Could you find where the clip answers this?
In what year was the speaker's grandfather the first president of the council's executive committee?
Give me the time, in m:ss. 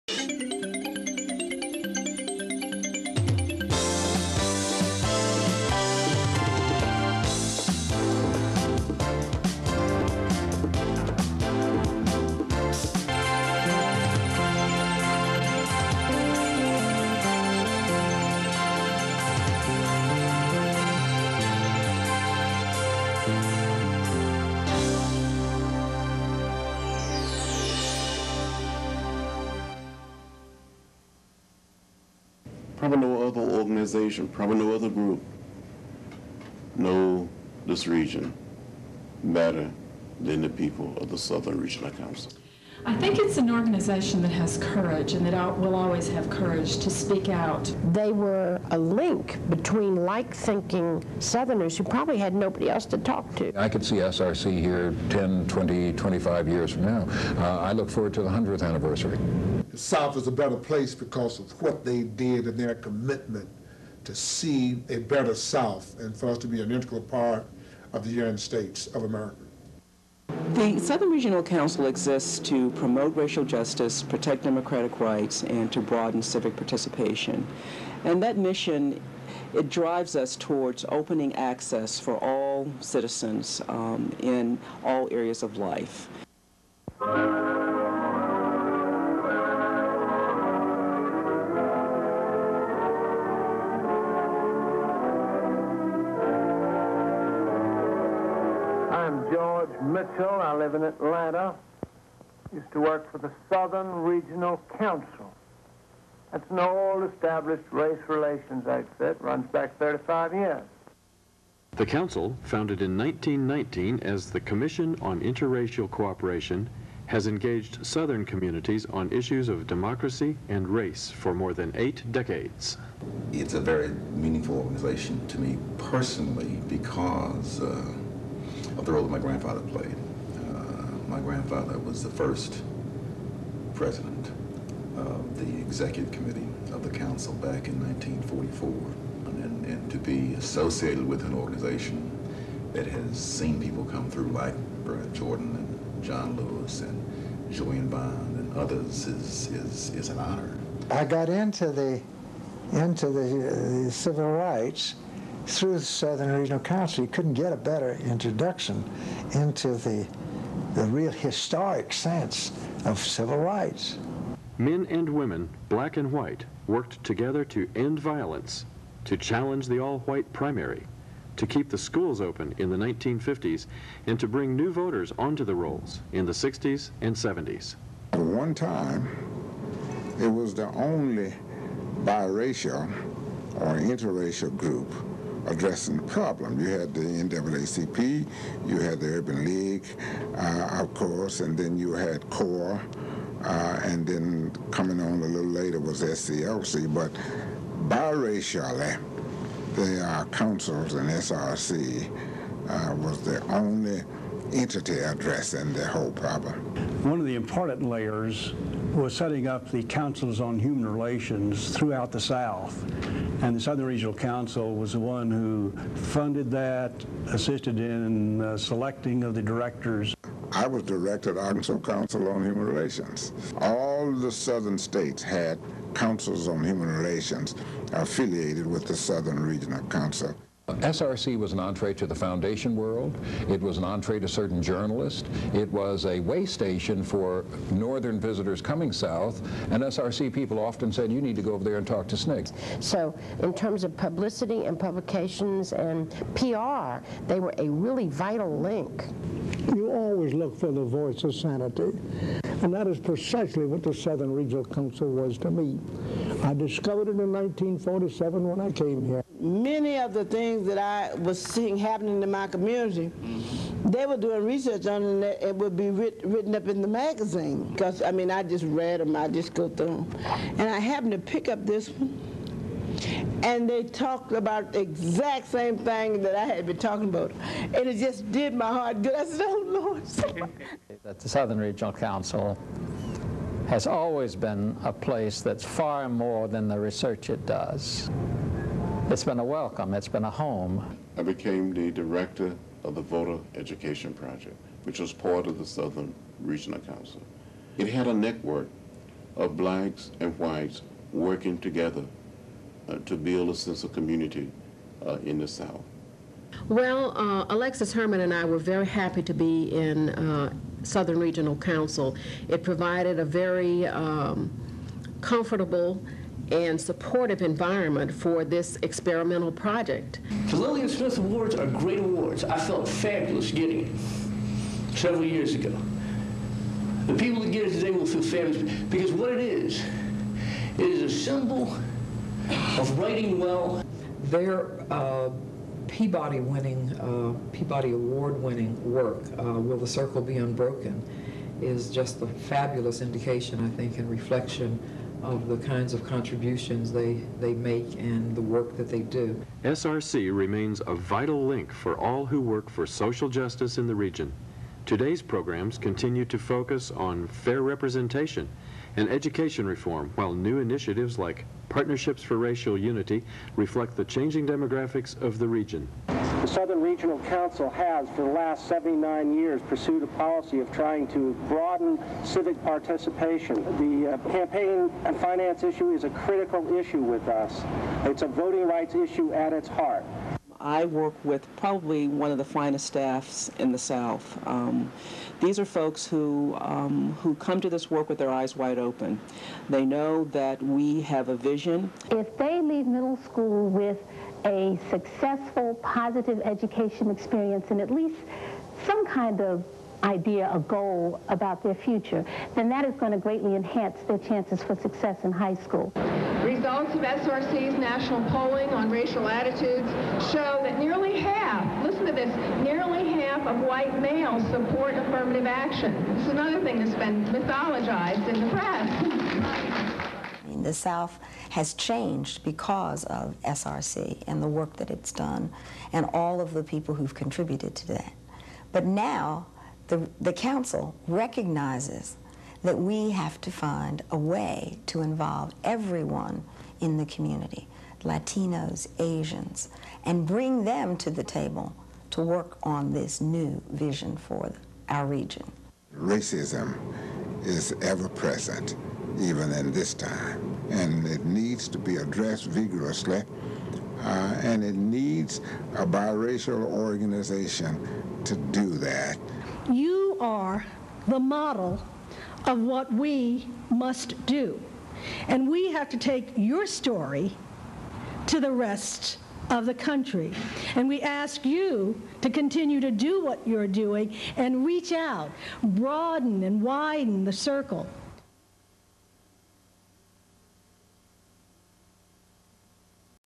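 2:17.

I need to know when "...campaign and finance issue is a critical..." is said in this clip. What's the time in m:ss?
6:14.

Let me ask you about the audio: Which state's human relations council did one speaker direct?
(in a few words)
Arkansas.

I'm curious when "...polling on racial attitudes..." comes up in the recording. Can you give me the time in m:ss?
6:48.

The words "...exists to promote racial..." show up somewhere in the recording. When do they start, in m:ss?
1:11.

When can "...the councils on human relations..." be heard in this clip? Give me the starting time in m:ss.
3:29.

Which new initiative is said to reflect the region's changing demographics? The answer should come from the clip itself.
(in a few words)
Partnerships for Racial Unity.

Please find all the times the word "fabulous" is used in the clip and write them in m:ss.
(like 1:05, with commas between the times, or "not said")
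5:22, 5:28, 5:42.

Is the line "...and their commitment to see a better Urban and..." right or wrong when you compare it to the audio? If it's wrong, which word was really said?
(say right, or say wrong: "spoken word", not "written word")
wrong: "South", not "Urban".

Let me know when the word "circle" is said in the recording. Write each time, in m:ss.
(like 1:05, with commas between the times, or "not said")
5:39, 7:57.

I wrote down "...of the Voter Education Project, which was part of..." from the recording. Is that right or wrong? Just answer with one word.
right.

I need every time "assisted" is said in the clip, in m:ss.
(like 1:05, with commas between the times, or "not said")
3:37.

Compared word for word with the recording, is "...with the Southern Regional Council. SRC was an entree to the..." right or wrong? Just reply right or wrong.
right.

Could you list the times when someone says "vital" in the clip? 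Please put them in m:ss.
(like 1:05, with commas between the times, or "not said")
4:08, 5:50.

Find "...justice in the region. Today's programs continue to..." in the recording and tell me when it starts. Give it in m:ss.
5:53.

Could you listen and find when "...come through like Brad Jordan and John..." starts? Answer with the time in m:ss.
2:23.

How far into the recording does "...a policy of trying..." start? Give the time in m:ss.
6:10.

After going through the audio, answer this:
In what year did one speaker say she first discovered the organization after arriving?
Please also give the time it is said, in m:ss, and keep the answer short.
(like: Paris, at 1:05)
1947, at 4:17.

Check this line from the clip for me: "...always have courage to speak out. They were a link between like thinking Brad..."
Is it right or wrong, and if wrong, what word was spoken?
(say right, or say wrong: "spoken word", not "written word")
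wrong: "Southerners", not "Brad".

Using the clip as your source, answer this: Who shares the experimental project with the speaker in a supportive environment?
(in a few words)
Alexis Herman.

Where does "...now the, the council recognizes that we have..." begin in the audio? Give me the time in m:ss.
7:08.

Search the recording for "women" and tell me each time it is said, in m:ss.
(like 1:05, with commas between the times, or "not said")
2:45.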